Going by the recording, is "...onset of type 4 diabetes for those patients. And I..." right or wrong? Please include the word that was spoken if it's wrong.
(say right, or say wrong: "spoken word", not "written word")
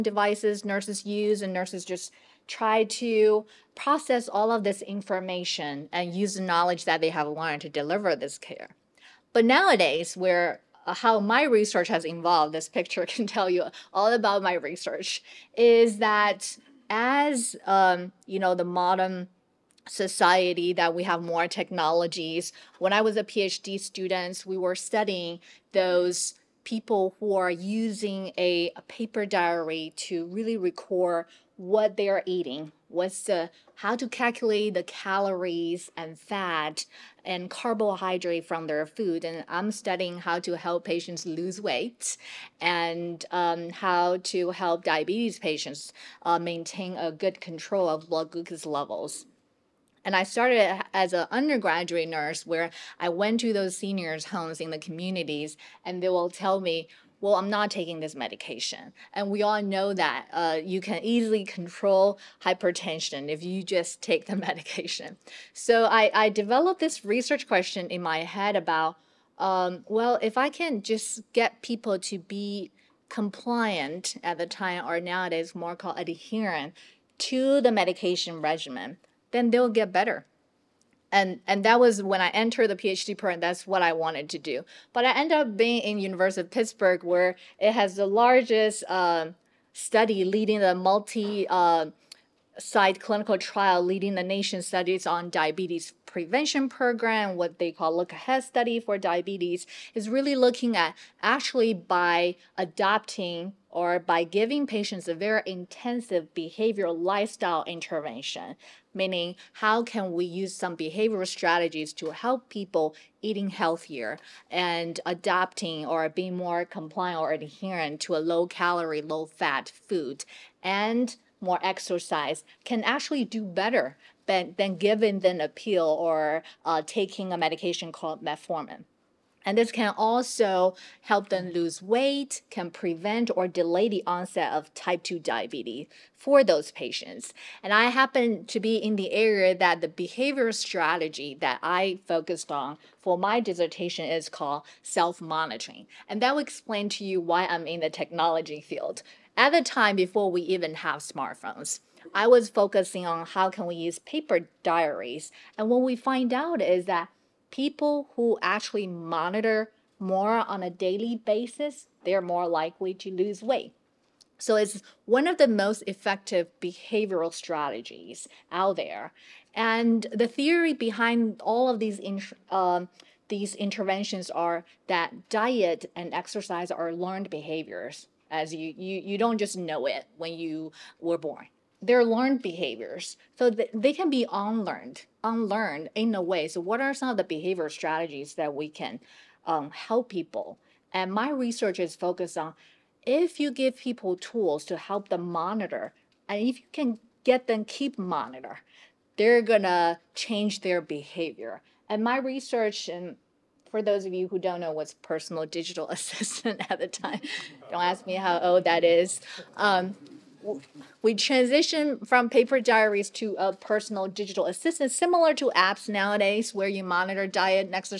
wrong: "2", not "4".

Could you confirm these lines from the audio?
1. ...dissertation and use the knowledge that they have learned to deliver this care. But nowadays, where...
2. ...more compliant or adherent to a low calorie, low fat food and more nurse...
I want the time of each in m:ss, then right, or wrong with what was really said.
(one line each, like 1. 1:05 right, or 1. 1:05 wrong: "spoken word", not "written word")
1. 0:04 wrong: "information", not "dissertation"
2. 1:56 wrong: "exercise", not "nurse".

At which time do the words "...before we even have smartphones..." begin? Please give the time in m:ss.
2:29.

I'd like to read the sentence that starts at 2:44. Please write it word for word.
So it's one of the most effective behavioral strategies out there.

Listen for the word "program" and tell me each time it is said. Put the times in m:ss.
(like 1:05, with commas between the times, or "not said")
1:23, 1:36.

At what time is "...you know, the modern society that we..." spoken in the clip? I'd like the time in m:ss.
0:18.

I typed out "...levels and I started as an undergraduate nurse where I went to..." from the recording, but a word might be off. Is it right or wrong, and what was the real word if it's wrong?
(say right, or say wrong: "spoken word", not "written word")
right.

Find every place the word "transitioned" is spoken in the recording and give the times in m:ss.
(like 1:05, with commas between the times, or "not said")
3:31.